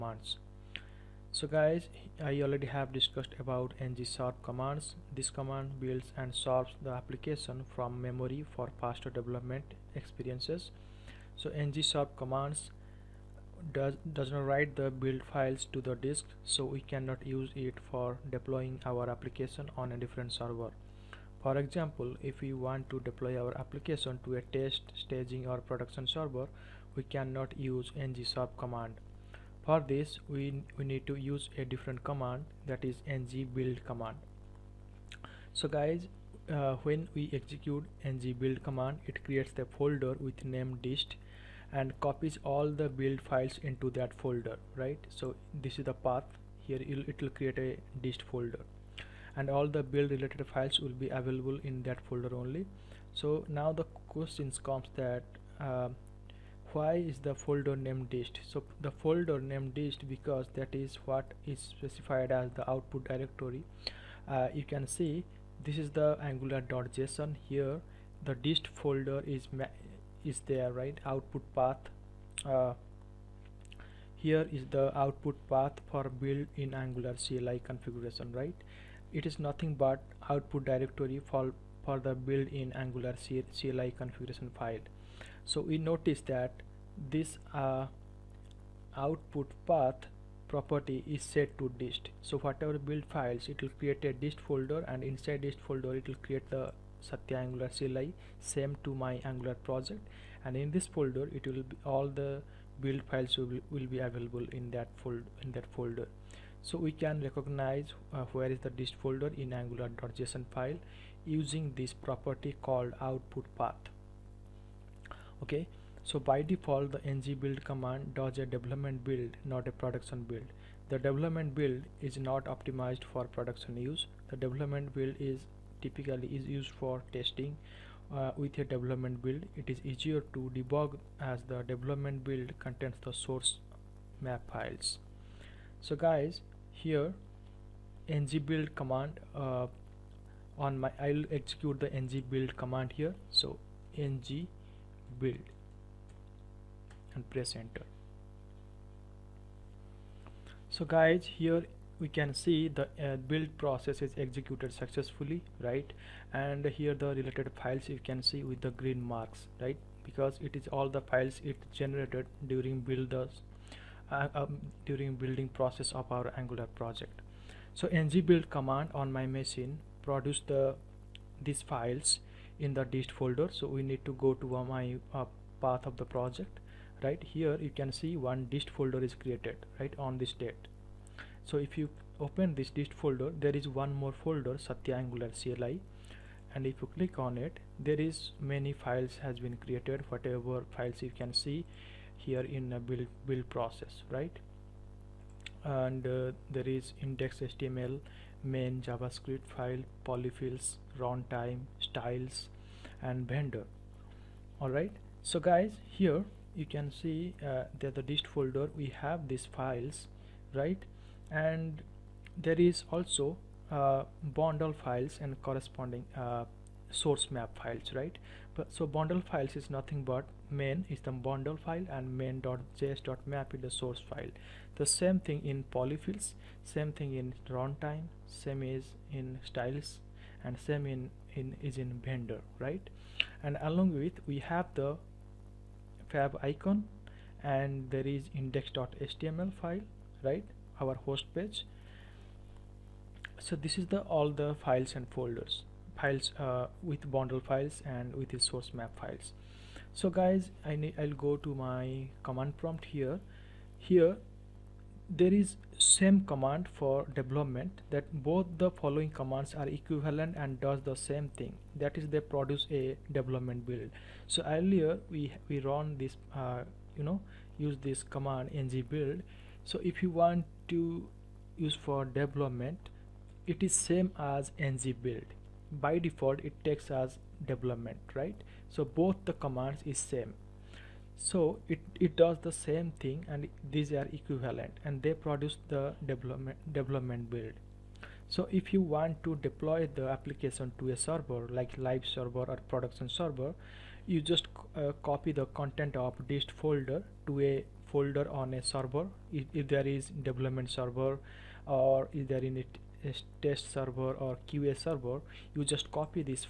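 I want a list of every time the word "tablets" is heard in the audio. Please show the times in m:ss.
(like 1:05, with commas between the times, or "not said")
not said.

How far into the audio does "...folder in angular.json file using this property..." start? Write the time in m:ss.
1:49.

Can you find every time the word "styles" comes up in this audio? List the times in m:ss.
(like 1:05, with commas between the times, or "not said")
3:21, 3:49.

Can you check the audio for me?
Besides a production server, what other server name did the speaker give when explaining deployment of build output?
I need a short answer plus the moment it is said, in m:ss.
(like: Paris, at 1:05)
live server, at 4:51.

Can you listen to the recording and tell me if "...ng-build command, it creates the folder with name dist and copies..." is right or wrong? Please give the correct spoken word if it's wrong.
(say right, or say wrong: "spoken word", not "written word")
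right.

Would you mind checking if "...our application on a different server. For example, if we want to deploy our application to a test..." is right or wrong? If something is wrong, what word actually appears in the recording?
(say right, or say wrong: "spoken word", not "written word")
right.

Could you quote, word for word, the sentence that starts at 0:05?
This command builds and serves the application from memory for faster development experiences.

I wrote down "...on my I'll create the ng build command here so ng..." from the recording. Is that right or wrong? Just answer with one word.
wrong.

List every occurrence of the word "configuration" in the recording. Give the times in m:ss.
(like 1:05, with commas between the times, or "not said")
1:17, 1:23.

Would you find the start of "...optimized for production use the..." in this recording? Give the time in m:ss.
2:02.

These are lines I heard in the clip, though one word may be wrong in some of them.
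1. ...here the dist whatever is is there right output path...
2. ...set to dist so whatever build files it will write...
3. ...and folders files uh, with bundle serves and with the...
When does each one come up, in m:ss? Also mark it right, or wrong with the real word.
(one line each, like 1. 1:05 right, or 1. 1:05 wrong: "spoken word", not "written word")
1. 1:07 wrong: "folder", not "whatever"
2. 1:31 wrong: "create", not "write"
3. 4:04 wrong: "files", not "serves".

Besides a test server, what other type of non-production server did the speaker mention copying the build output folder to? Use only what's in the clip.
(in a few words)
QA server.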